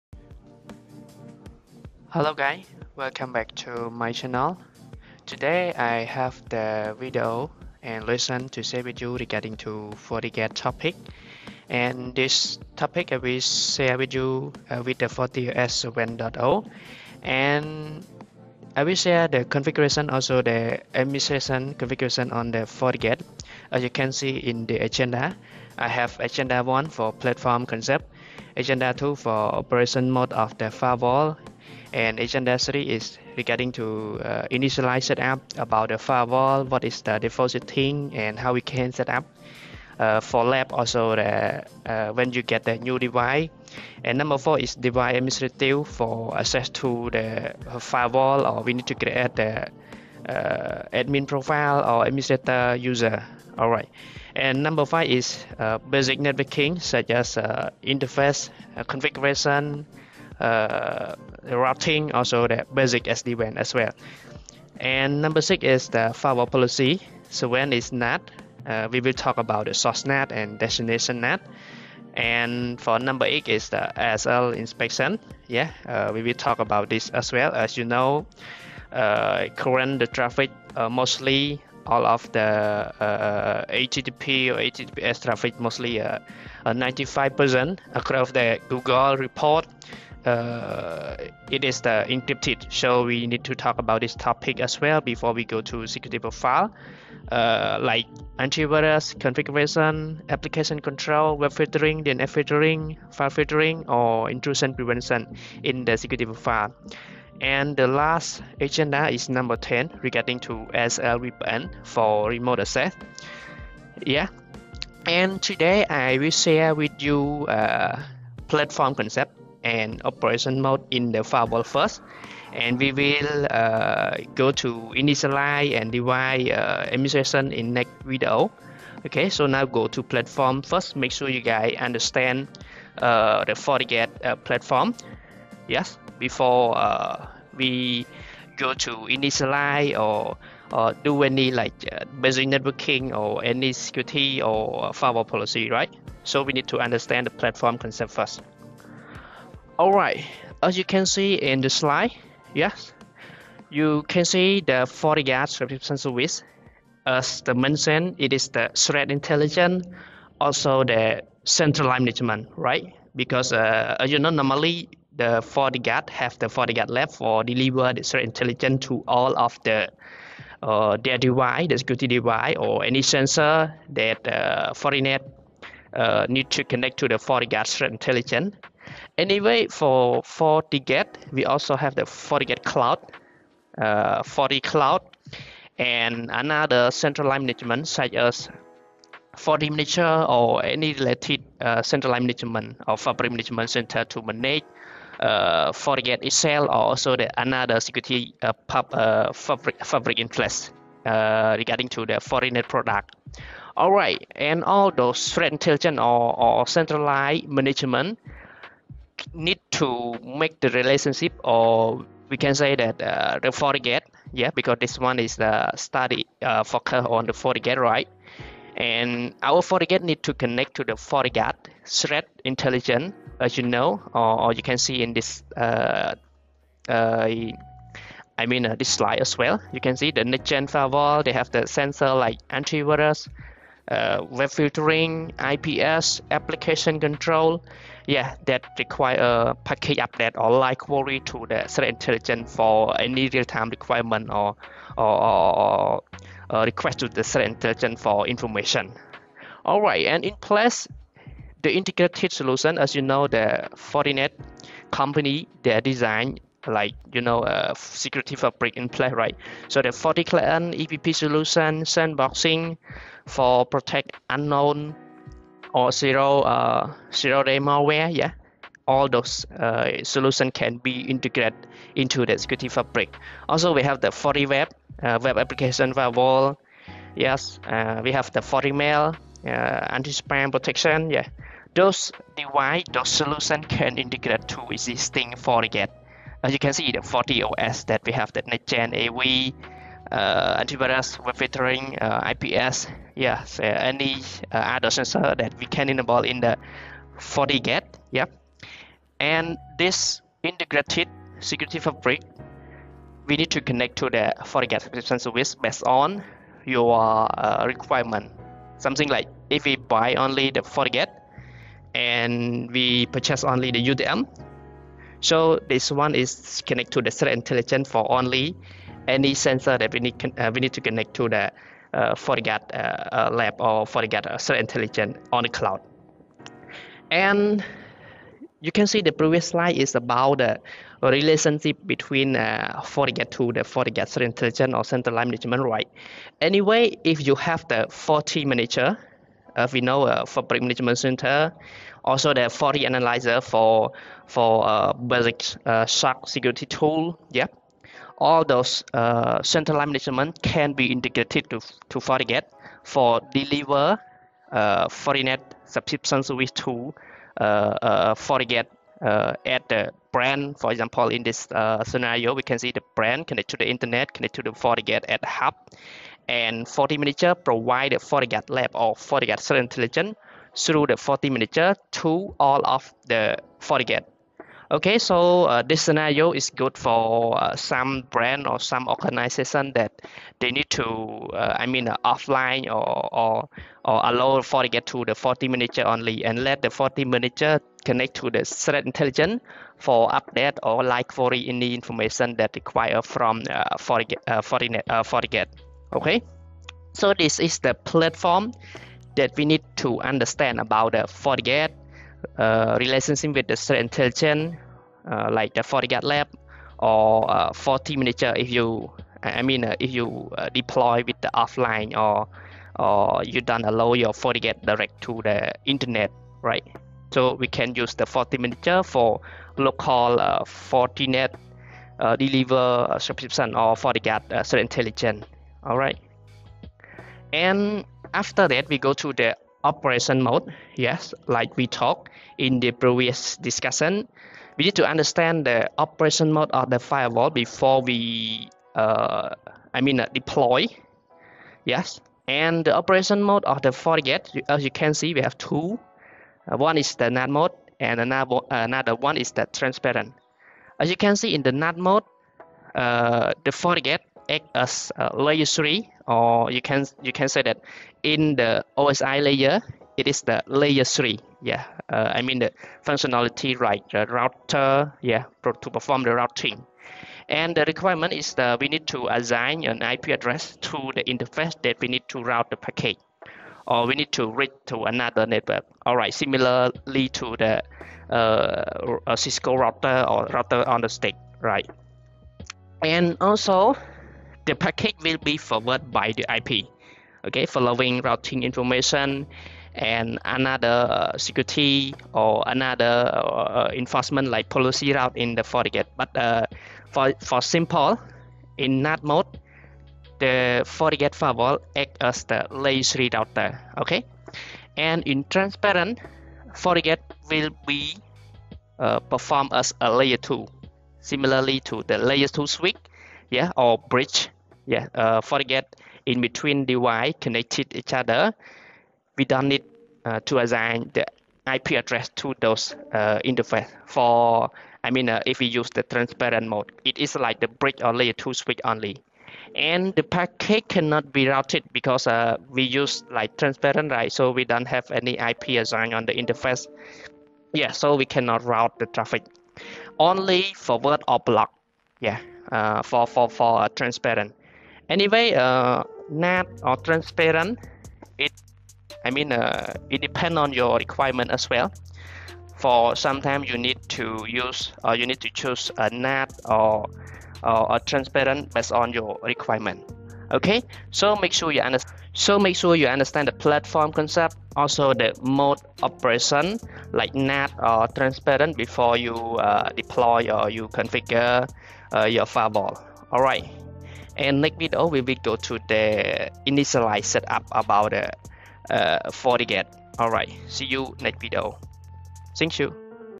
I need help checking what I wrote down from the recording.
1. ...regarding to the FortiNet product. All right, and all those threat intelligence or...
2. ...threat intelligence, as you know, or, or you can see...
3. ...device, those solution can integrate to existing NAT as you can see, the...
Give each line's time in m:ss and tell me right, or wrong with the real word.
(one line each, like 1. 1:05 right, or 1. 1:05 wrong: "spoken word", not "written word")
1. 3:21 right
2. 3:41 right
3. 4:42 wrong: "FortiGate", not "NAT".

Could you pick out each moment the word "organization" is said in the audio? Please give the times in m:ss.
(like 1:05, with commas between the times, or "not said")
6:18.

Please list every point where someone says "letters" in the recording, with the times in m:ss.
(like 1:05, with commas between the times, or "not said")
not said.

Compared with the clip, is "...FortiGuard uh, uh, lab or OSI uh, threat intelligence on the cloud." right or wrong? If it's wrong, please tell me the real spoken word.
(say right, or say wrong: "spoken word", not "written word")
wrong: "FortiGuard", not "OSI".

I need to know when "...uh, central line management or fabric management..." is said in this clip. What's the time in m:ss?
3:11.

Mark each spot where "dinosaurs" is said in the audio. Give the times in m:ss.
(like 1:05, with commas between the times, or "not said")
not said.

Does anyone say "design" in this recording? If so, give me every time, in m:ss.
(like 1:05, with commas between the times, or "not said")
4:15.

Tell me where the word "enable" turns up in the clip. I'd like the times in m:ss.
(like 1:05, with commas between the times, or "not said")
4:55.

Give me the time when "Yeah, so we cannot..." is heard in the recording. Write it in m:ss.
8:57.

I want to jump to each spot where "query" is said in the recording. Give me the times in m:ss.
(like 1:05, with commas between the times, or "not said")
4:00, 6:31.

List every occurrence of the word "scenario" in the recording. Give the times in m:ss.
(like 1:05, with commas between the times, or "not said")
6:01, 6:15.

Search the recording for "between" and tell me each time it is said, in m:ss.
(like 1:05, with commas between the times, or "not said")
5:31, 8:36.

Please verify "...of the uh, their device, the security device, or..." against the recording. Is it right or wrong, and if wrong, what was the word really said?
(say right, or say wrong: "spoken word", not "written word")
right.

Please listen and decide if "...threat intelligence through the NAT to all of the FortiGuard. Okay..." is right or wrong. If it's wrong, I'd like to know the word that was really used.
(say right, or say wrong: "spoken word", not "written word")
wrong: "FortiManager", not "NAT".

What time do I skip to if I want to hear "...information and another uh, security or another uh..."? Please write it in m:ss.
8:08.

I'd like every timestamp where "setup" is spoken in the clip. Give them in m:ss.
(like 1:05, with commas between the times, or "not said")
0:35, 9:37.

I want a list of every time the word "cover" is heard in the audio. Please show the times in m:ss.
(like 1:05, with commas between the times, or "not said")
not said.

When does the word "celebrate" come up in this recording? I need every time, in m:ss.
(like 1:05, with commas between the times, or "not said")
not said.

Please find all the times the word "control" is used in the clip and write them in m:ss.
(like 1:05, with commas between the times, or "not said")
1:40, 3:56.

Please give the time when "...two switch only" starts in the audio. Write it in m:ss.
8:48.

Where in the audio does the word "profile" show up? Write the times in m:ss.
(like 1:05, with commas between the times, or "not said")
0:51, 1:36, 1:46.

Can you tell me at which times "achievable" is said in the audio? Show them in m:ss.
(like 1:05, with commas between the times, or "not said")
not said.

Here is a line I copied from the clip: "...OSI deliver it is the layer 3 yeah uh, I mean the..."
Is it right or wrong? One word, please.
wrong.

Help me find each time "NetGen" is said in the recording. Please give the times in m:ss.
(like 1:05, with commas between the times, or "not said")
4:48.